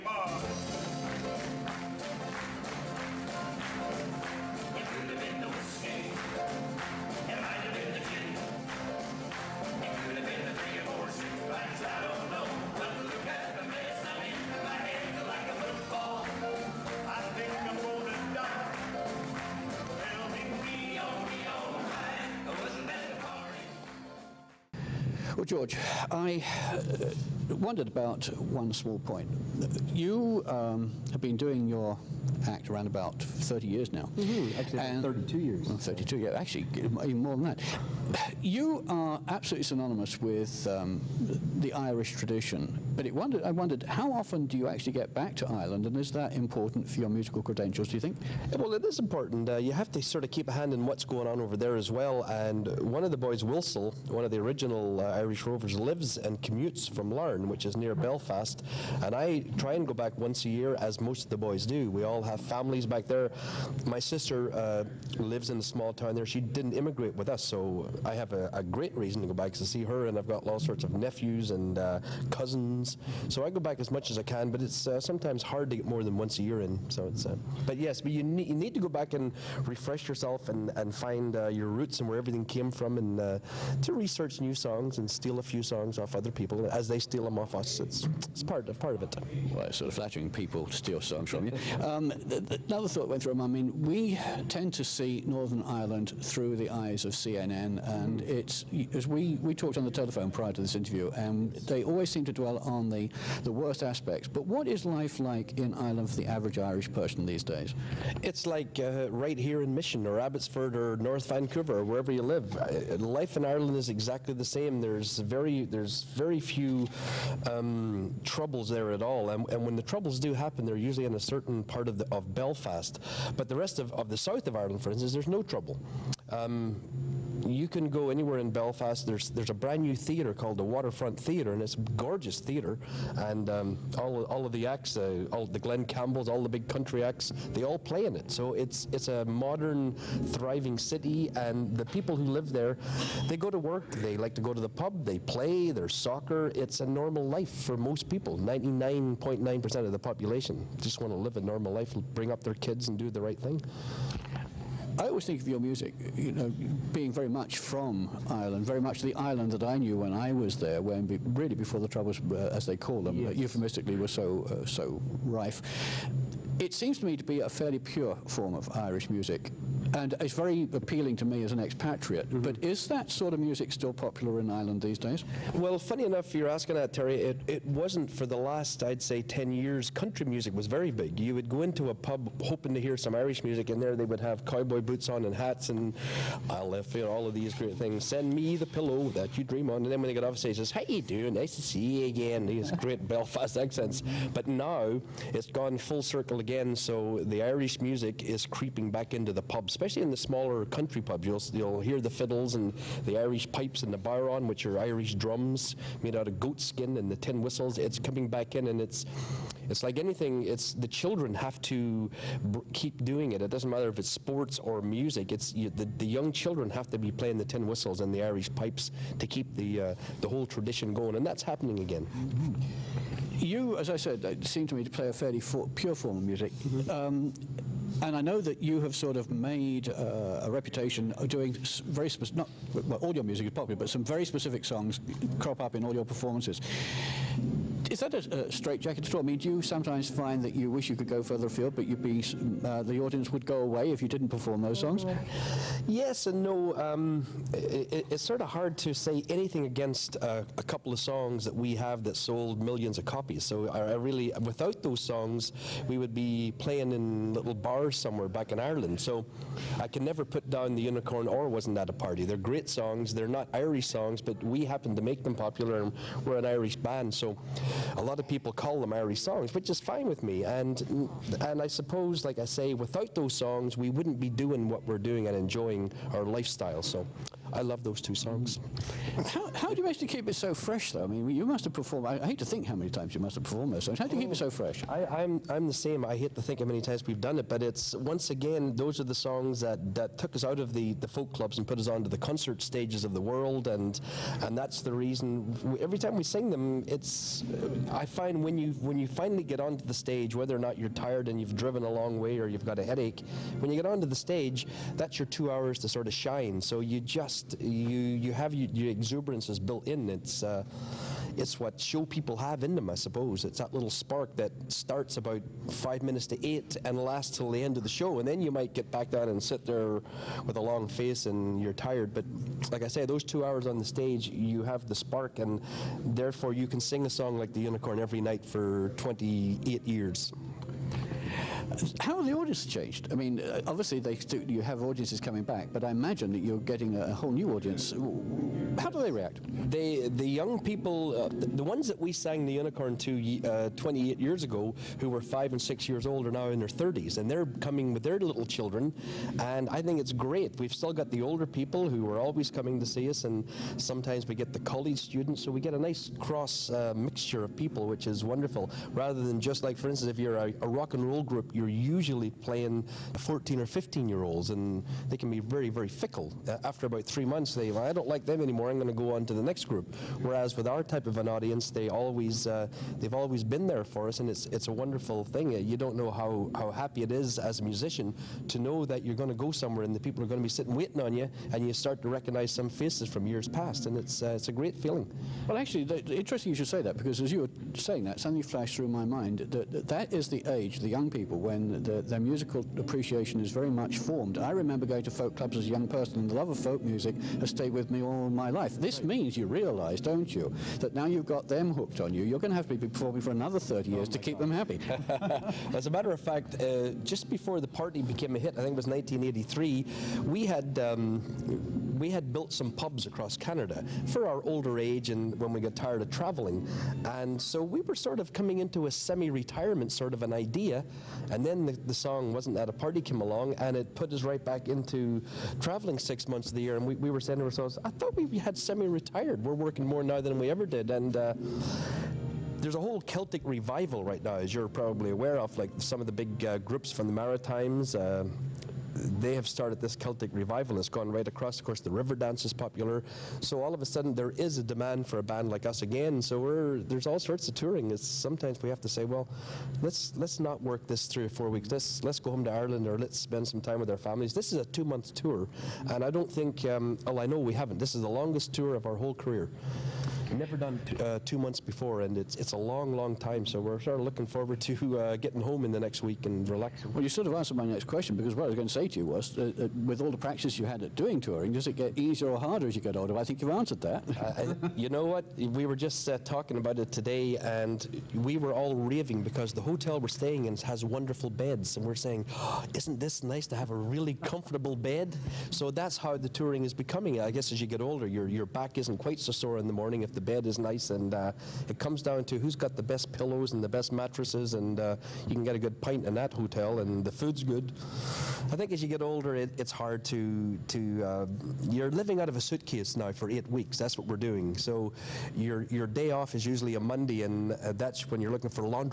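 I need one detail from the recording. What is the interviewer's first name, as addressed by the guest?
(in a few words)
Terry.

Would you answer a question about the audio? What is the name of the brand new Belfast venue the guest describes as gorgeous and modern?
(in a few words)
Waterfront Theatre.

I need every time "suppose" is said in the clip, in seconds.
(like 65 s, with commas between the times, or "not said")
271 s, 312 s.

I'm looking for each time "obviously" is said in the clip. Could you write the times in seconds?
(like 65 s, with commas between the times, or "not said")
333 s.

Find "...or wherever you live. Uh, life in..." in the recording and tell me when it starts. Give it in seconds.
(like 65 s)
111 s.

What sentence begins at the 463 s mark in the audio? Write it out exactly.
So we're sort of looking forward to uh, getting home in the next week and relaxing.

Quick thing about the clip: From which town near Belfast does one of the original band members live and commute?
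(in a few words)
Larne.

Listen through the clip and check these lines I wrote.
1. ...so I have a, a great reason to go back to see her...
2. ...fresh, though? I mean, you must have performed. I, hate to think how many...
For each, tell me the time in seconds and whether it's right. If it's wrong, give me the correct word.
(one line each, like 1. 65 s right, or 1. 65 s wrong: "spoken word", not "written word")
1. 67 s right
2. 280 s right.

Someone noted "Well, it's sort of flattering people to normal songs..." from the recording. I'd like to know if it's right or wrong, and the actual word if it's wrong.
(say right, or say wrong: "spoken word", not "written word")
wrong: "steal", not "normal".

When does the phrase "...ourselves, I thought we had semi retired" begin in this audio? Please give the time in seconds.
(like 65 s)
427 s.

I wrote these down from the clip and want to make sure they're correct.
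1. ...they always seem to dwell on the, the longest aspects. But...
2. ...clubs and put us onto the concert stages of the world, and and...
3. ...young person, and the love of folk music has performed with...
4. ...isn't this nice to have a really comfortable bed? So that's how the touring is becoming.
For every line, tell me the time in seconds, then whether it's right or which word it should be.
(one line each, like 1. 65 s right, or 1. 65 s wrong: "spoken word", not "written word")
1. 101 s wrong: "worst", not "longest"
2. 291 s right
3. 395 s wrong: "stayed", not "performed"
4. 482 s right.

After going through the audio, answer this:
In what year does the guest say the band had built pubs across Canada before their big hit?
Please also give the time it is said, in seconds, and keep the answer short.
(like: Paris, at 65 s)
1983, at 408 s.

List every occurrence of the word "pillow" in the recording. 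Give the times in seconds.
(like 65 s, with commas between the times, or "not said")
188 s, 493 s.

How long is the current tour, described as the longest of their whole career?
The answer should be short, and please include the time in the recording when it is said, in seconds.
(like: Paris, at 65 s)
2 months, at 454 s.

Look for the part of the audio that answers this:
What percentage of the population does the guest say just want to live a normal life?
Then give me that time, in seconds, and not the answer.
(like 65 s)
148 s.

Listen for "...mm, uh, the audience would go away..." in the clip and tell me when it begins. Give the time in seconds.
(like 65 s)
242 s.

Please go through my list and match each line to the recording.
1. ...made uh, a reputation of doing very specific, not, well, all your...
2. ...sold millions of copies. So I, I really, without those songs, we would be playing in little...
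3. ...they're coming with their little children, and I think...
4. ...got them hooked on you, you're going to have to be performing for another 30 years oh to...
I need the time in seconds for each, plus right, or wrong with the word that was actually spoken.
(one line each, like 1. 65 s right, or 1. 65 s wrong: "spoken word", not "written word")
1. 229 s right
2. 252 s right
3. 347 s right
4. 401 s right.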